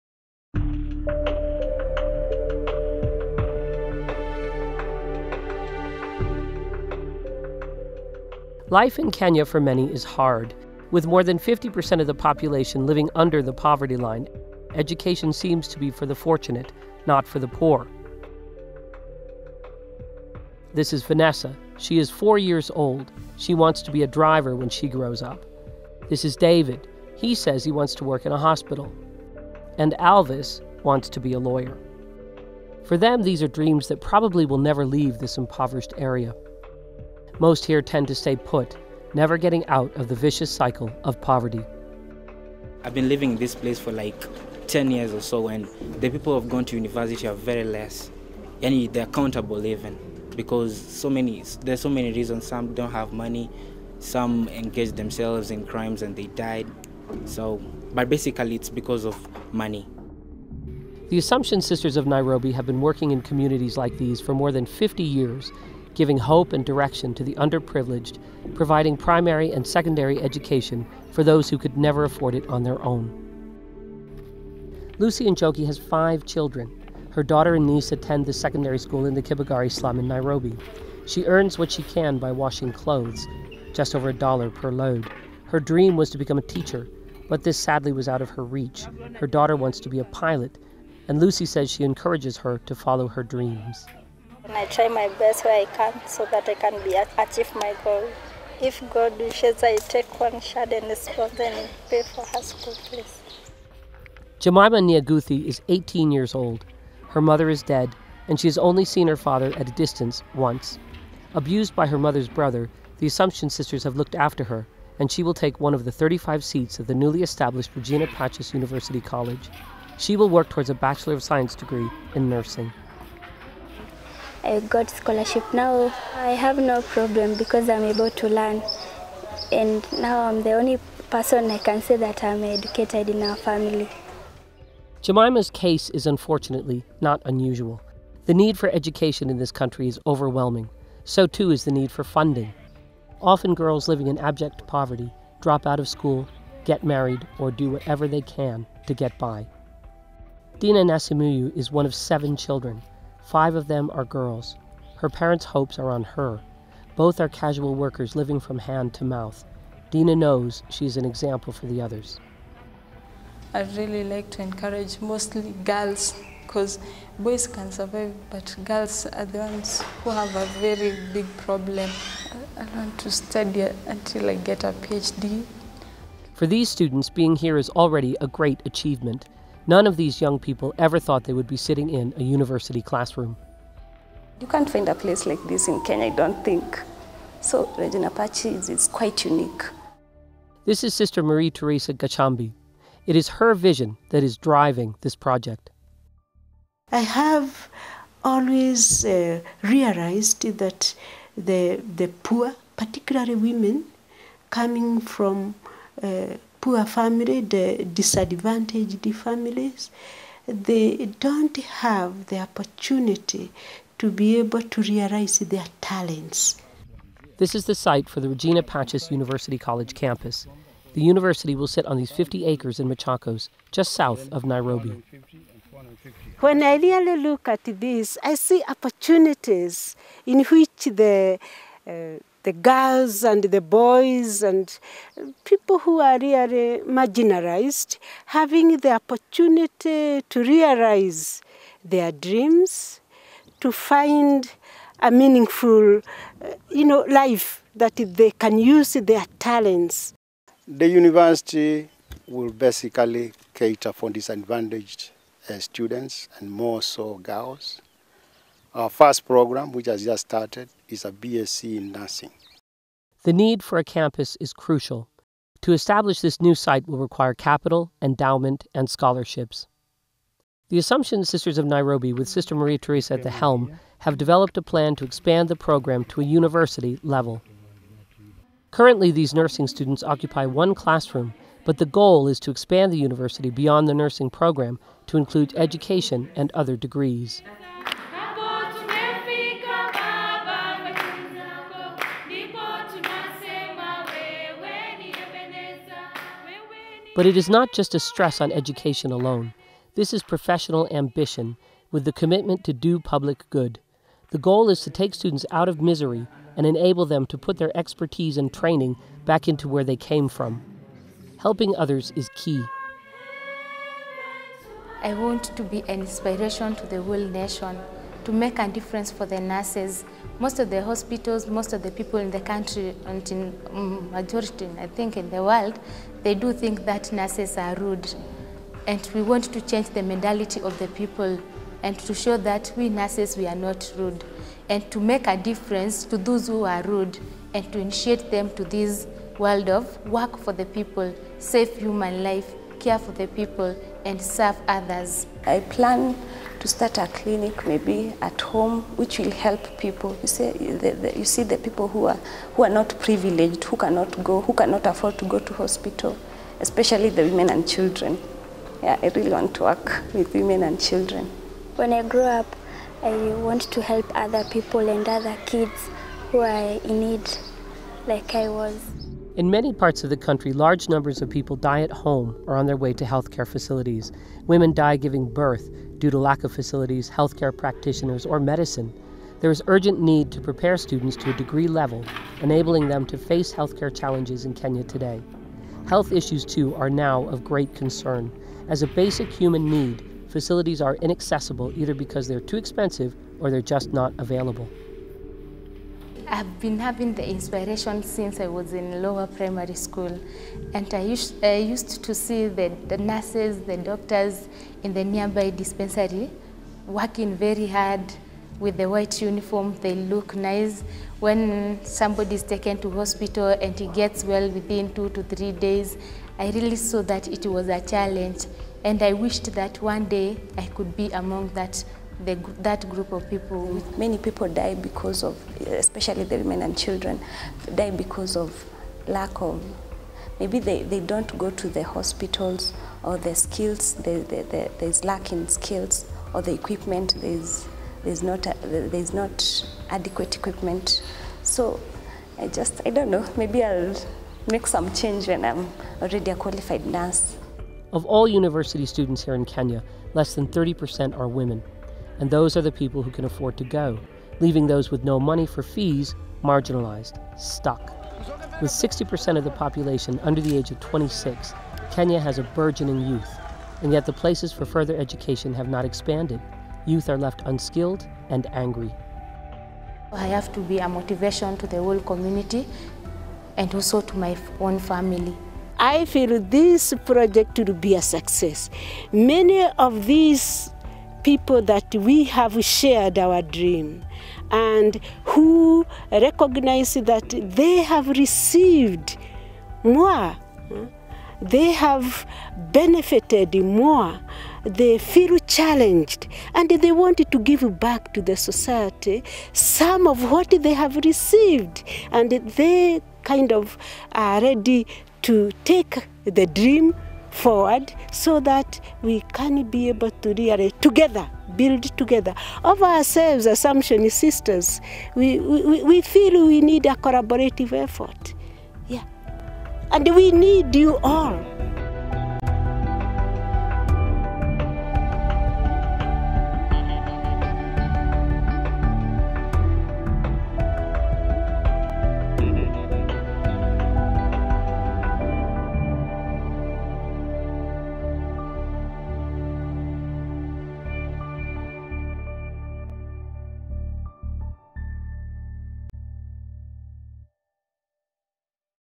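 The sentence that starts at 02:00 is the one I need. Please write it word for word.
She will work towards a Bachelor of Science degree in nursing.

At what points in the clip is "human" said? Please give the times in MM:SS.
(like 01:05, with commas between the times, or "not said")
05:41, 06:29.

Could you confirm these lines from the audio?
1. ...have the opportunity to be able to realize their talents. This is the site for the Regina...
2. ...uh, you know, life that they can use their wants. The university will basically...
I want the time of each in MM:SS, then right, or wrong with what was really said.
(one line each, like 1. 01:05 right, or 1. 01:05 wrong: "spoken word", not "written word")
1. 03:31 right
2. 04:05 wrong: "talents", not "wants".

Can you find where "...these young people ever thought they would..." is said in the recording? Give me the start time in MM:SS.
02:59.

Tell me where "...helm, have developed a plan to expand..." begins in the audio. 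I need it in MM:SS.
04:33.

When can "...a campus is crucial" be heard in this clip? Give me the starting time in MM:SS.
04:23.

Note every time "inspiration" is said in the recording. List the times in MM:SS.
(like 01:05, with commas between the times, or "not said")
05:16, 06:37.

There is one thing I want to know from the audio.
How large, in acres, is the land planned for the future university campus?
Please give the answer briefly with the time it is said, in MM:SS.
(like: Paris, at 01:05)
50 acres, at 03:42.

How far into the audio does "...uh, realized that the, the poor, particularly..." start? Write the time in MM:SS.
03:19.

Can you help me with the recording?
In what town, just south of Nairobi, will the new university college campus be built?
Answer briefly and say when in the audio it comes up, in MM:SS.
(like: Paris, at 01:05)
Machakos, at 03:42.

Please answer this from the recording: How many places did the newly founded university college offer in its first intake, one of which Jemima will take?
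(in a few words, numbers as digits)
35.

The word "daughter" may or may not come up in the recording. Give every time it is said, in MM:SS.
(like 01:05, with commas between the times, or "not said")
01:17, 01:29.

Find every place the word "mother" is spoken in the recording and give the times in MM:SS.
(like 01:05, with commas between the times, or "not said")
01:47, 01:51.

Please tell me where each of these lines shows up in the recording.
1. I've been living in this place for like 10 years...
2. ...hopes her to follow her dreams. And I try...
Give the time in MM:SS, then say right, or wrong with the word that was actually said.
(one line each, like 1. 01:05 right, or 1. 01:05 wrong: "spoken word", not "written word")
1. 00:42 right
2. 01:31 wrong: "encourages", not "hopes".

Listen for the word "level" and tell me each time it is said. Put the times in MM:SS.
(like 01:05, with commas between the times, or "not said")
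04:37, 06:21.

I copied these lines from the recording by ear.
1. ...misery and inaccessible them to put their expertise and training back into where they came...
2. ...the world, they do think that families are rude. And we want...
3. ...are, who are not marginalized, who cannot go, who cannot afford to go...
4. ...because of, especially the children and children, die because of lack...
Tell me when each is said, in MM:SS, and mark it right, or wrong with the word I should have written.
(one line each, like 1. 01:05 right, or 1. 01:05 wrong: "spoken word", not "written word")
1. 05:05 wrong: "enable", not "inaccessible"
2. 05:25 wrong: "nurses", not "families"
3. 05:52 wrong: "privileged", not "marginalized"
4. 07:04 wrong: "women", not "children".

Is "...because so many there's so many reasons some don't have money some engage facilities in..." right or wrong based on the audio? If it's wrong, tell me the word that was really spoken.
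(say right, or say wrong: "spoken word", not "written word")
wrong: "themselves", not "facilities".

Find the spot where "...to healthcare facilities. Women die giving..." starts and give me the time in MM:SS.
06:12.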